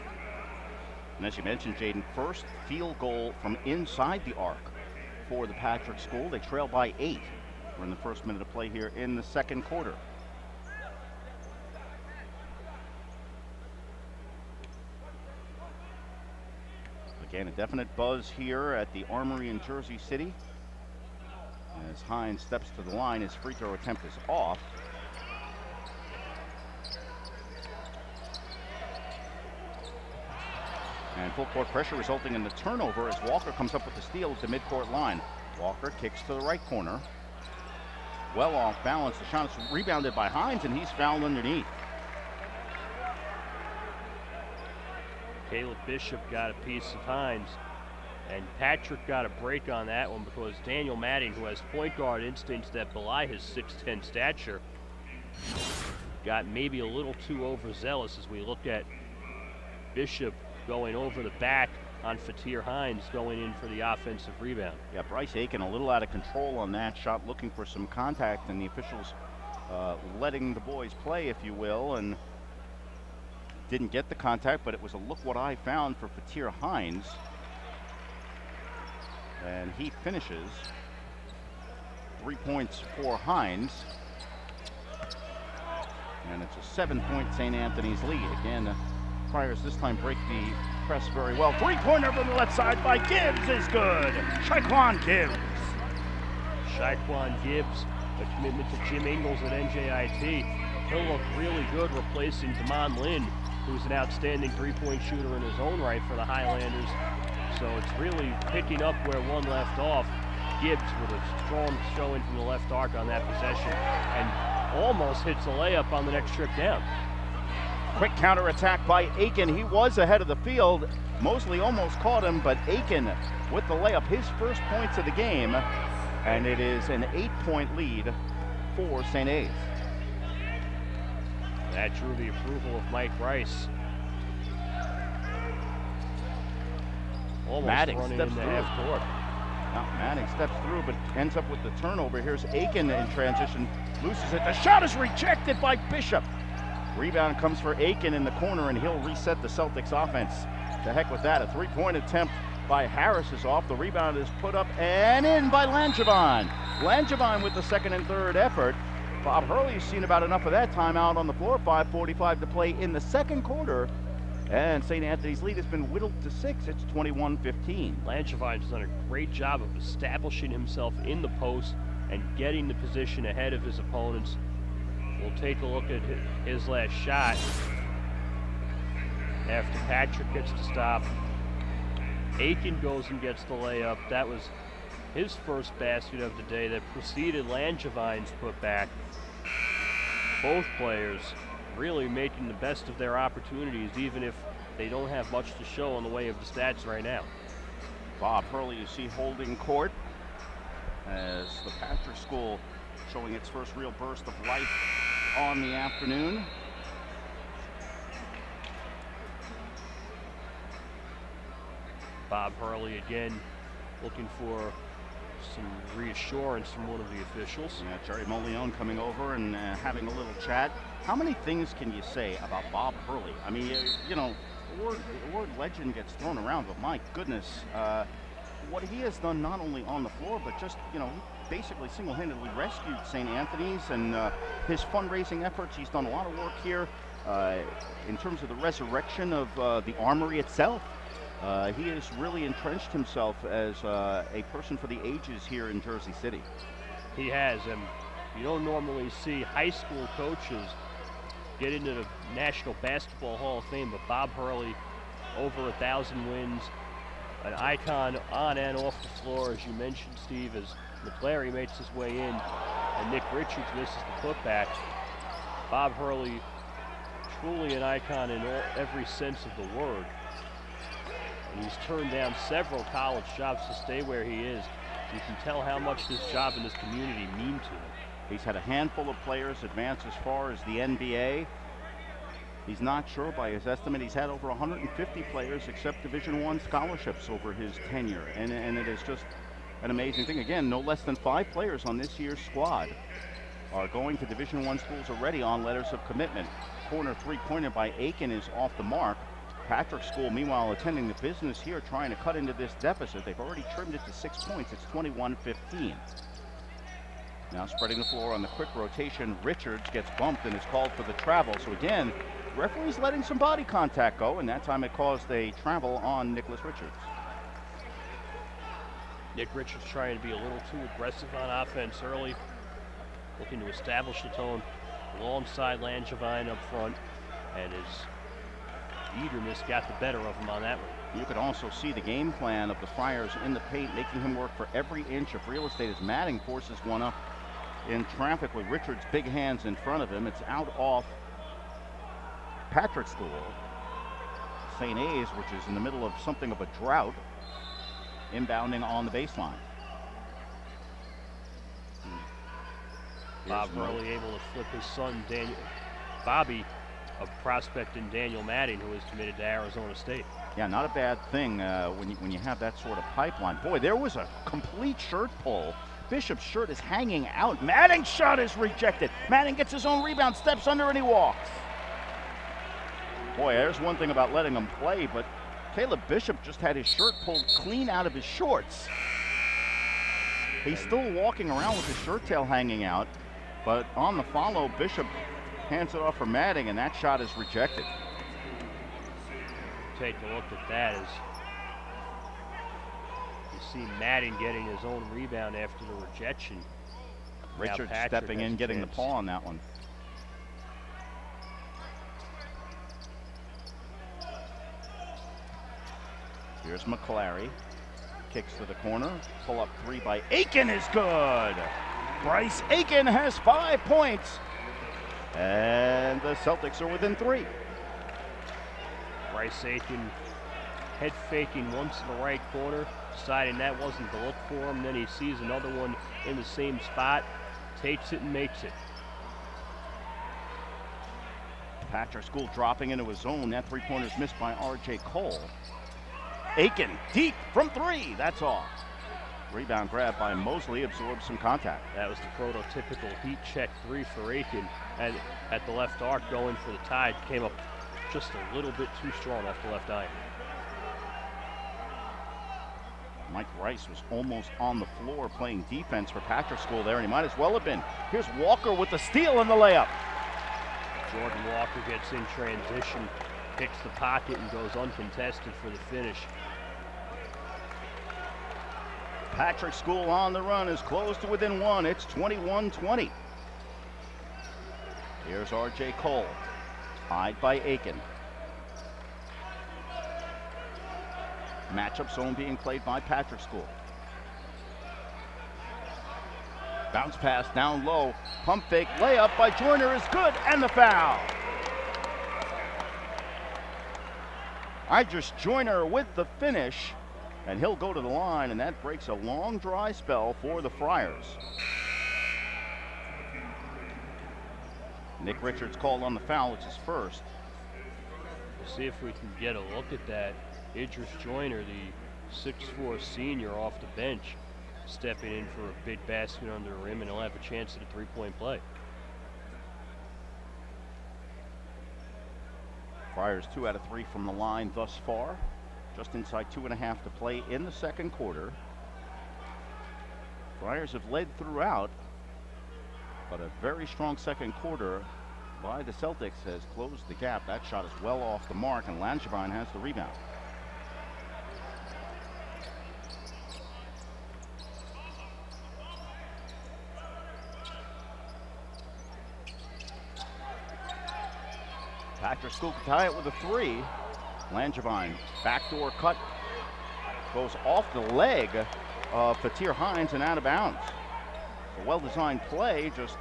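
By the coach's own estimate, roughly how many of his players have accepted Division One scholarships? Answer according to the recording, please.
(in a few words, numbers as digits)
Over 150.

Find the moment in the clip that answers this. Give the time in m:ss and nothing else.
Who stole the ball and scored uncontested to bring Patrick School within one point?
7:41.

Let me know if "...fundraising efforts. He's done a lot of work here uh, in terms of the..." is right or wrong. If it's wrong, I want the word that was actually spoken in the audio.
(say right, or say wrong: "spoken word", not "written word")
right.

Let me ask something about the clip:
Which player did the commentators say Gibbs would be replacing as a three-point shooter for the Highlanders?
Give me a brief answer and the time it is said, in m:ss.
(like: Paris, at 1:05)
Damon Lynn, at 1:42.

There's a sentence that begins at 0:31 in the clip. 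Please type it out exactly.
And full court pressure resulting in the turnover as Walker comes up with the steal at the midcourt line.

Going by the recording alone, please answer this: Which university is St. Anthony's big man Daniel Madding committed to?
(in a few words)
Arizona State.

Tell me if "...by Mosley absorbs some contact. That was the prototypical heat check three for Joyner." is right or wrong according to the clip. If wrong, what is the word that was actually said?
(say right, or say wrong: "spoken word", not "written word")
wrong: "Aiken", not "Joyner".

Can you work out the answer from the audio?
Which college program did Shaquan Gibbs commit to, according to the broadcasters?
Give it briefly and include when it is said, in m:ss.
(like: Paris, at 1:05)
NJIT, at 1:39.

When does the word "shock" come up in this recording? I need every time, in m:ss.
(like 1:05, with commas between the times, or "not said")
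not said.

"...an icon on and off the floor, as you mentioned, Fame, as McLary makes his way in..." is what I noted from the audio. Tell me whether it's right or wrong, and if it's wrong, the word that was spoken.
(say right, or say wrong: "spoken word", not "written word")
wrong: "Steve", not "Fame".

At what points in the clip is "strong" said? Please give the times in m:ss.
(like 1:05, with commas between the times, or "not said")
1:51, 7:29, 8:53.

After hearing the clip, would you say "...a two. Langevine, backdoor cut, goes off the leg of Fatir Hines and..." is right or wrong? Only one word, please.
wrong.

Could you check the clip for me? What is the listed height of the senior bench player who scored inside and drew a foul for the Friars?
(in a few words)
6'4.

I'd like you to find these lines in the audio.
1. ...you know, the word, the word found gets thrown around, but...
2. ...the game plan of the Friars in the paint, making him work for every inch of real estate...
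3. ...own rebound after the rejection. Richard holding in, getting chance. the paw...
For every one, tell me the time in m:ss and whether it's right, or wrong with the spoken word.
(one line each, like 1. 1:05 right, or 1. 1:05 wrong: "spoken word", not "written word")
1. 3:44 wrong: "legend", not "found"
2. 5:31 right
3. 6:34 wrong: "stepping", not "holding".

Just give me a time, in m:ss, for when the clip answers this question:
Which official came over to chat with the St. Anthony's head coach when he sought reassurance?
3:38.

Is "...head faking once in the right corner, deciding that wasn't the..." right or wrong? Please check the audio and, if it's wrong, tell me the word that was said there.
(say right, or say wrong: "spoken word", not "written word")
right.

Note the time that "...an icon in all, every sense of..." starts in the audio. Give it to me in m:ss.
4:27.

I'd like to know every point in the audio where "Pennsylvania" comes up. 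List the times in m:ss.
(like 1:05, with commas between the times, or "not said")
not said.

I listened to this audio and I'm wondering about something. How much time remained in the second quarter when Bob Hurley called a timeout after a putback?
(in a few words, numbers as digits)
5:45.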